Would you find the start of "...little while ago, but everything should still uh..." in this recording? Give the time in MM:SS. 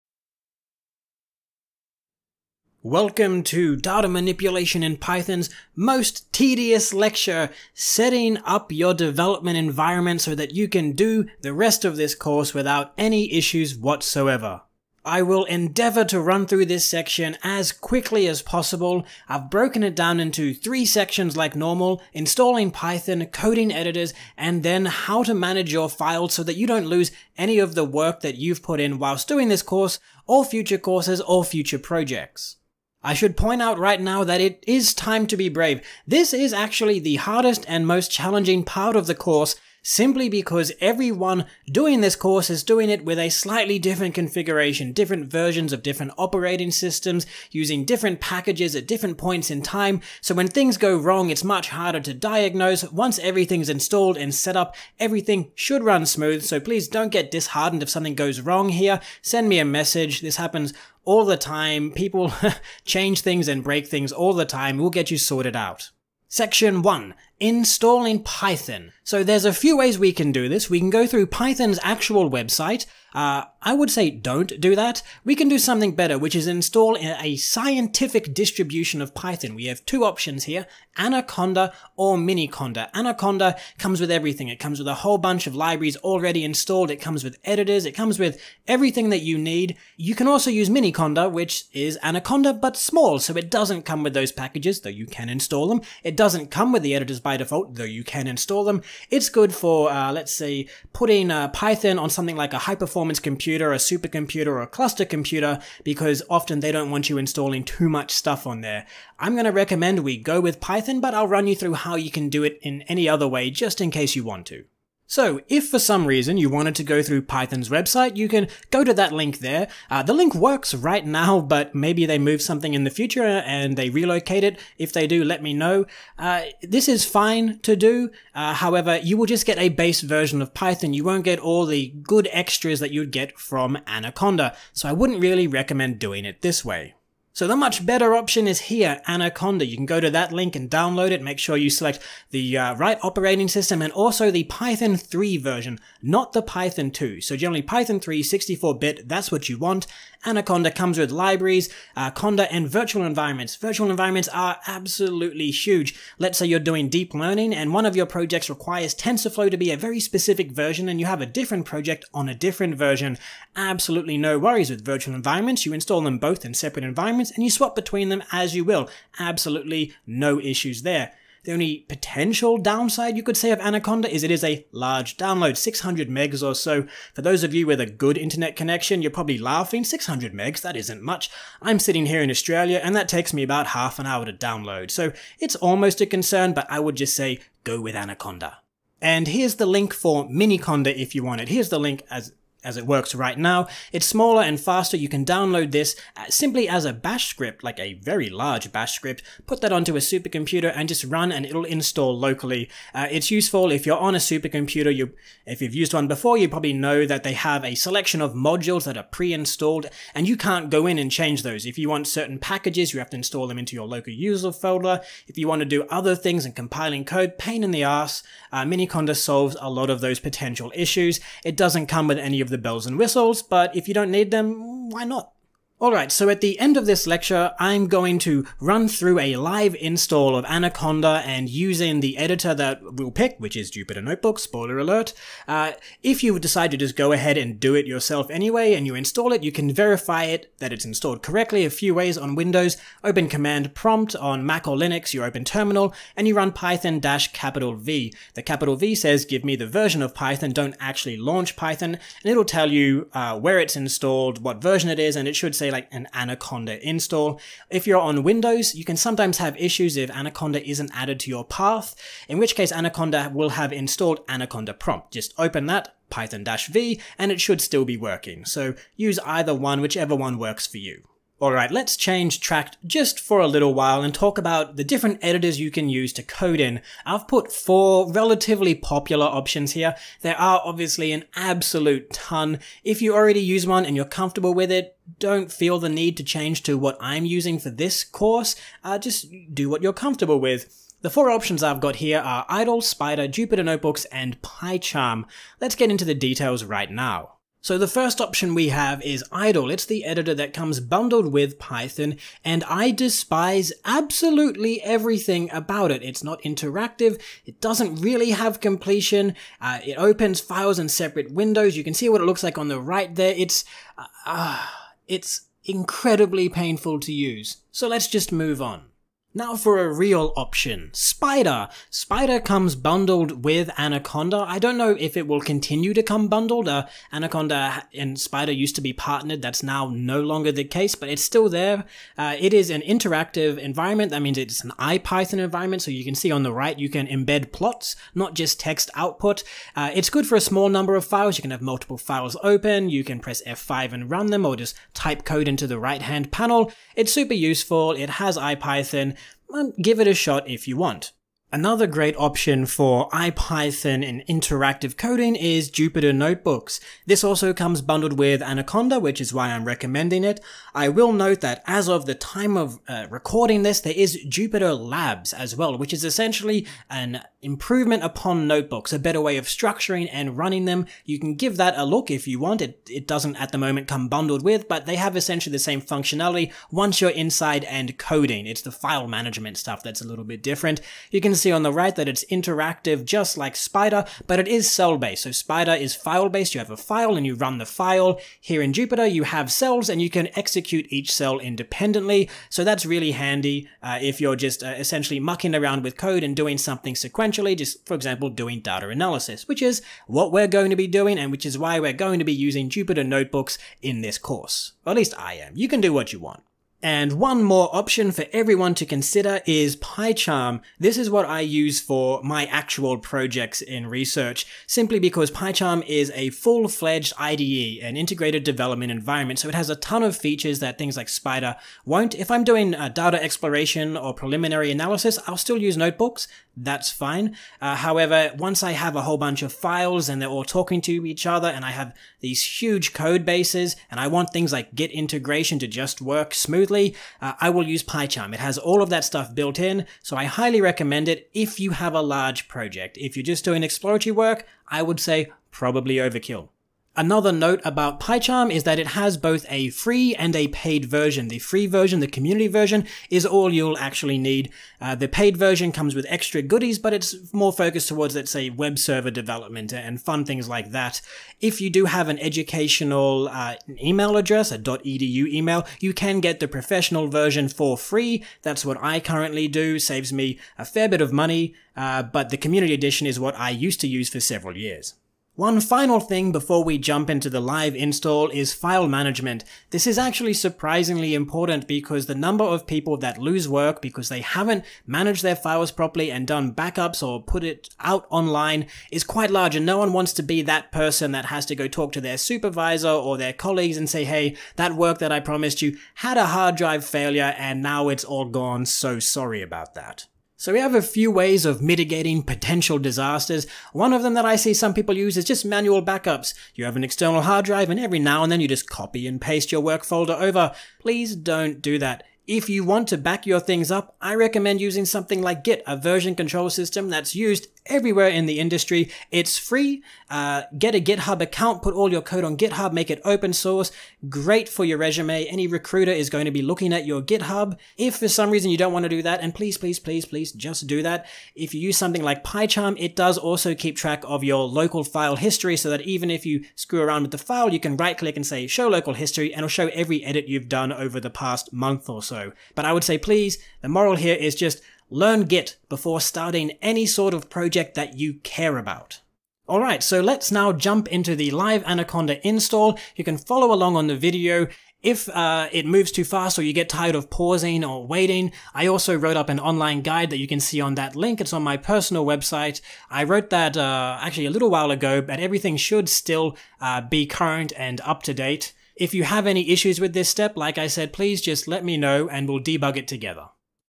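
09:24.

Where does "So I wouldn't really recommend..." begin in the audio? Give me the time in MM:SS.
02:14.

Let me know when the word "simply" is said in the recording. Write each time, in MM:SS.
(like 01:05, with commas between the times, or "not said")
00:39, 03:16, 06:54.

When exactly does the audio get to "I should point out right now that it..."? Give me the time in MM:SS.
00:33.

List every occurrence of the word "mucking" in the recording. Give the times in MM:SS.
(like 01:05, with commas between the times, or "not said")
06:35.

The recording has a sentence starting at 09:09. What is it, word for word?
Alright, so let's now jump into the live Anaconda install.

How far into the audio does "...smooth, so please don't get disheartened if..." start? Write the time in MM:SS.
00:56.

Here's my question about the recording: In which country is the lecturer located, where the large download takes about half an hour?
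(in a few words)
Australia.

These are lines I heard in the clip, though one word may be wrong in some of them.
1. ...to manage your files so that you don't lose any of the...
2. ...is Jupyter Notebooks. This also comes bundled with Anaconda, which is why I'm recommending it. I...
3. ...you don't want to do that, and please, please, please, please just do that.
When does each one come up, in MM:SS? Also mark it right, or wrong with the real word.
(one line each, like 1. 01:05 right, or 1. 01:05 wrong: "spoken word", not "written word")
1. 00:25 right
2. 05:55 right
3. 08:48 right.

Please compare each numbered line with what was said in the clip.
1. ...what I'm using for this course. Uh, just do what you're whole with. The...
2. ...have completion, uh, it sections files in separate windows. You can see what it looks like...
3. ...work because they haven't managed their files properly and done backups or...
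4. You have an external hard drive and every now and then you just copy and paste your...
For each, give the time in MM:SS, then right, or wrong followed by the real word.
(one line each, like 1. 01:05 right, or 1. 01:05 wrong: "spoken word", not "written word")
1. 04:46 wrong: "comfortable", not "whole"
2. 05:08 wrong: "opens", not "sections"
3. 08:03 right
4. 08:26 right.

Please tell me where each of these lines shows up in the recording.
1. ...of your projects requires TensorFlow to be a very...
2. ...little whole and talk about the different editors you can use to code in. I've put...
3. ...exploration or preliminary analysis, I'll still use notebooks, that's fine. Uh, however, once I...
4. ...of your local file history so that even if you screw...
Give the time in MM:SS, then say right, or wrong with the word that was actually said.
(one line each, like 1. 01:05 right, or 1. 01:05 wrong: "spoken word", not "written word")
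1. 02:37 right
2. 04:33 wrong: "while", not "whole"
3. 07:03 right
4. 08:54 right.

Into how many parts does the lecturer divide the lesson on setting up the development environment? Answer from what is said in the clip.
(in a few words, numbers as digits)
3.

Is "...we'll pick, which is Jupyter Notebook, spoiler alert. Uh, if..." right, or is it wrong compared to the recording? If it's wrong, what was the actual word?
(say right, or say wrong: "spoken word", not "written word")
right.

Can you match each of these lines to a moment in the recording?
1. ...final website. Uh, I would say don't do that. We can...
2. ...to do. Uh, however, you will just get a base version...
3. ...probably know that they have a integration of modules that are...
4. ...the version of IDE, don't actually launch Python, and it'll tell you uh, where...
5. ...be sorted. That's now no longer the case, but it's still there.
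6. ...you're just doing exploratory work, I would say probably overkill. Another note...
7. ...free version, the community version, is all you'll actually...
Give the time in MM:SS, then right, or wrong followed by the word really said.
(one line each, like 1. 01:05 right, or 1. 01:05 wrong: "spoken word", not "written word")
1. 01:11 wrong: "actual", not "final"
2. 02:07 right
3. 03:26 wrong: "selection", not "integration"
4. 04:09 wrong: "Python", not "IDE"
5. 05:28 wrong: "partnered", not "sorted"
6. 07:23 right
7. 07:31 right.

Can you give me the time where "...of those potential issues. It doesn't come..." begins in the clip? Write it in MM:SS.
03:39.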